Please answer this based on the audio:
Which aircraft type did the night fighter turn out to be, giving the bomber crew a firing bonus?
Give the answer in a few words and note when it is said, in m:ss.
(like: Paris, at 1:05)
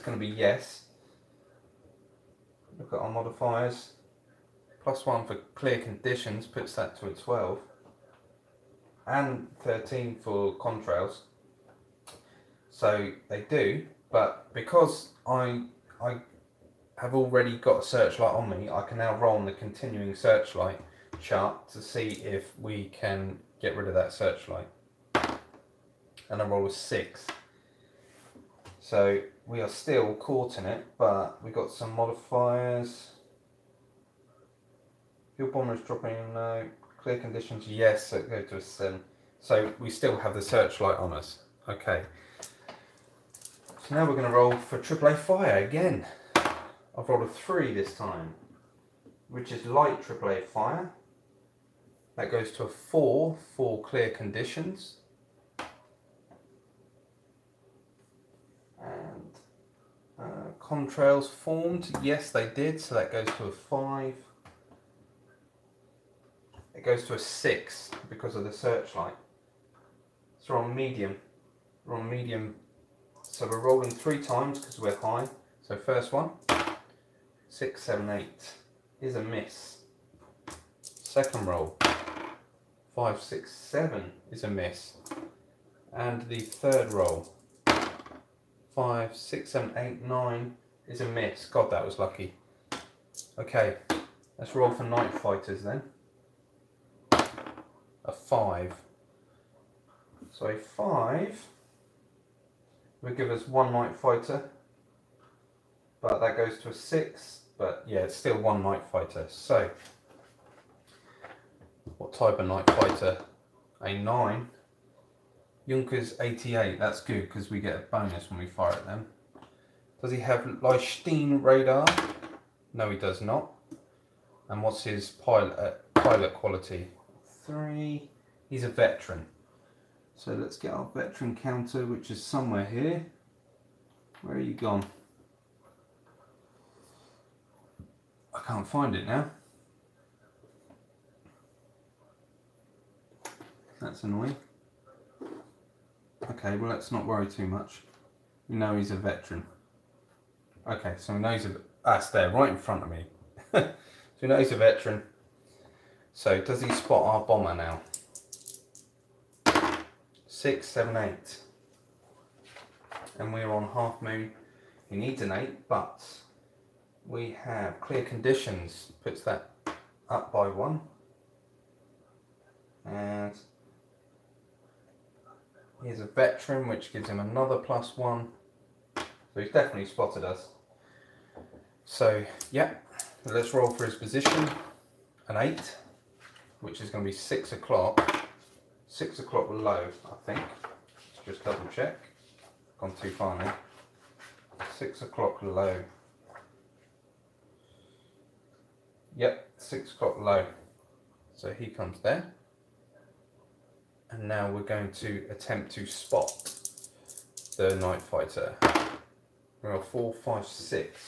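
Junkers 88, at 1:55.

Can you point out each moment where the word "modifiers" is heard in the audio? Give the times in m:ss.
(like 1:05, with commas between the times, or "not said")
0:03, 0:31.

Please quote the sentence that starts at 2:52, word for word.
And here's a veteran, which gives him another plus one.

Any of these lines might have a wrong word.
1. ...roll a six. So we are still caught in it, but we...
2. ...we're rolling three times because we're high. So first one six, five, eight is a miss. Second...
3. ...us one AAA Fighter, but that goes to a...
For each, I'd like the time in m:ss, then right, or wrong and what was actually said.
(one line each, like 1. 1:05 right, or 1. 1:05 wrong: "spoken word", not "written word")
1. 0:26 right
2. 1:13 wrong: "seven", not "five"
3. 1:43 wrong: "Night", not "AAA".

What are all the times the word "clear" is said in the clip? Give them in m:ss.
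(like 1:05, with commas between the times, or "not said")
0:05, 0:37, 0:53, 2:47.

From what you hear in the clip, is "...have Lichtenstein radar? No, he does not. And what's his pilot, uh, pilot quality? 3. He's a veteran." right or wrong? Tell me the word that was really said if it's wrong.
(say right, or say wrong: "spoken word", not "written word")
right.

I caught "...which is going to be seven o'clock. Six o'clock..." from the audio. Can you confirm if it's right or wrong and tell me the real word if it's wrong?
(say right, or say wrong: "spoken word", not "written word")
wrong: "six", not "seven".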